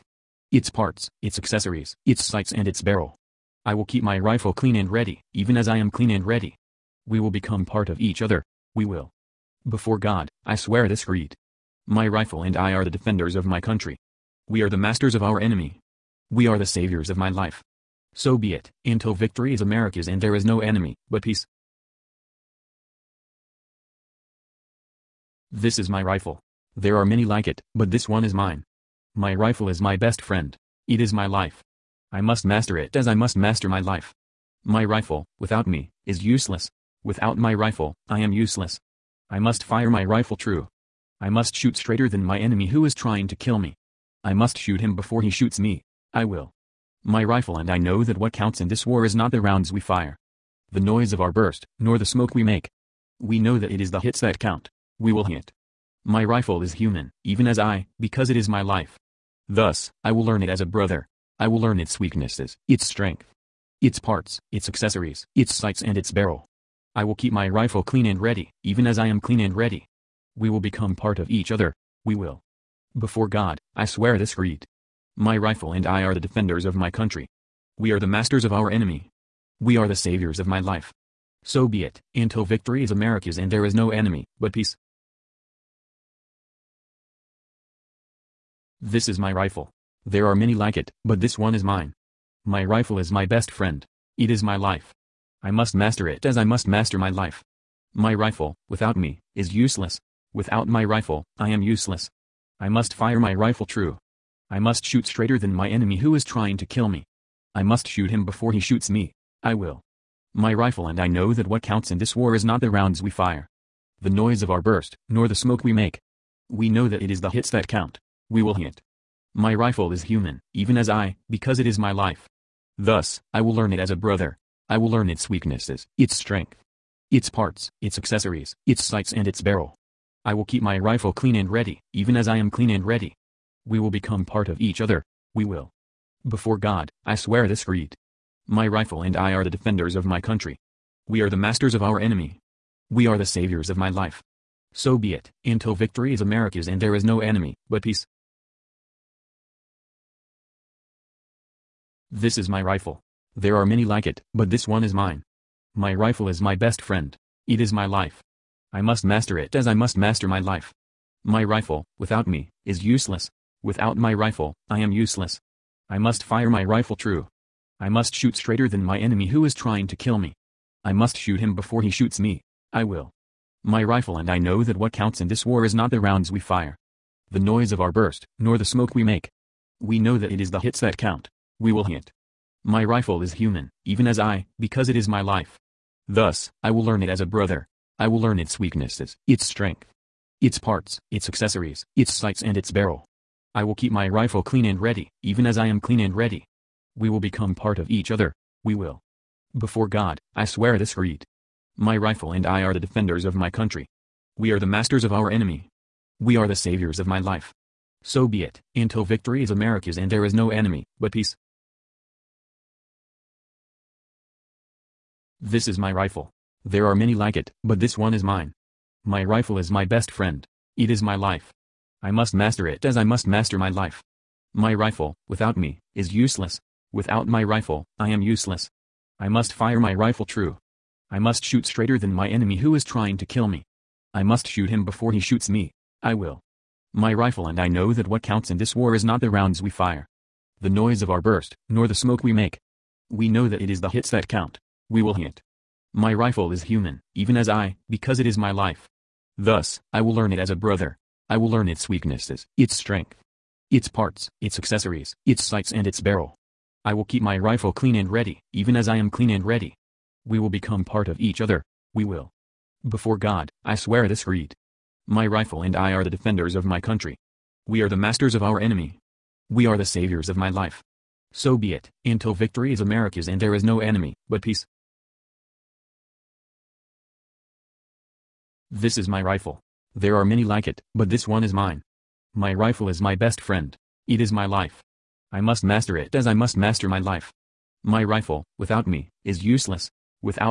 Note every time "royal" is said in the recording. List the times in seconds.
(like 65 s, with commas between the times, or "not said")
not said.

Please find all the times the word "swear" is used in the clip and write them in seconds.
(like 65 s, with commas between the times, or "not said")
10 s, 73 s, 137 s, 200 s, 263 s.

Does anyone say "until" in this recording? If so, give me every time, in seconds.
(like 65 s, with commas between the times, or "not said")
18 s, 82 s, 145 s, 208 s, 272 s.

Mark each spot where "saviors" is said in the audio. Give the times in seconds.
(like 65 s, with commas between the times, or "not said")
16 s, 79 s, 143 s, 206 s, 269 s.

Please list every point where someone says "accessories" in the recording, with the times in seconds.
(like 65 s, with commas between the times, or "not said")
1 s, 64 s, 127 s, 191 s, 254 s.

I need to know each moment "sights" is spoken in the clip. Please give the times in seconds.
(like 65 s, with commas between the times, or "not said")
2 s, 65 s, 128 s, 192 s, 255 s.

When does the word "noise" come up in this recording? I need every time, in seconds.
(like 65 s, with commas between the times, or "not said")
50 s, 114 s, 177 s, 240 s.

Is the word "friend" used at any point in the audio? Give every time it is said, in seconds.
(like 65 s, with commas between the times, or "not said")
30 s, 93 s, 156 s, 220 s, 283 s.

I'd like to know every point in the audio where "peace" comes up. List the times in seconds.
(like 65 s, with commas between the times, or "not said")
21 s, 84 s, 147 s, 211 s, 274 s.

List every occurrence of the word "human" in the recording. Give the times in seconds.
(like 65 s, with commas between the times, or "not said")
56 s, 120 s, 183 s, 246 s.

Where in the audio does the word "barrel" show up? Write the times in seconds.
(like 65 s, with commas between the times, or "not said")
2 s, 66 s, 129 s, 192 s, 256 s.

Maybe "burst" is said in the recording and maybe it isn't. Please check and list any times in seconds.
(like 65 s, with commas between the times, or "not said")
51 s, 114 s, 177 s, 241 s.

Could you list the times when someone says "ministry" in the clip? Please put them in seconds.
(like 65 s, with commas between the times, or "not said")
not said.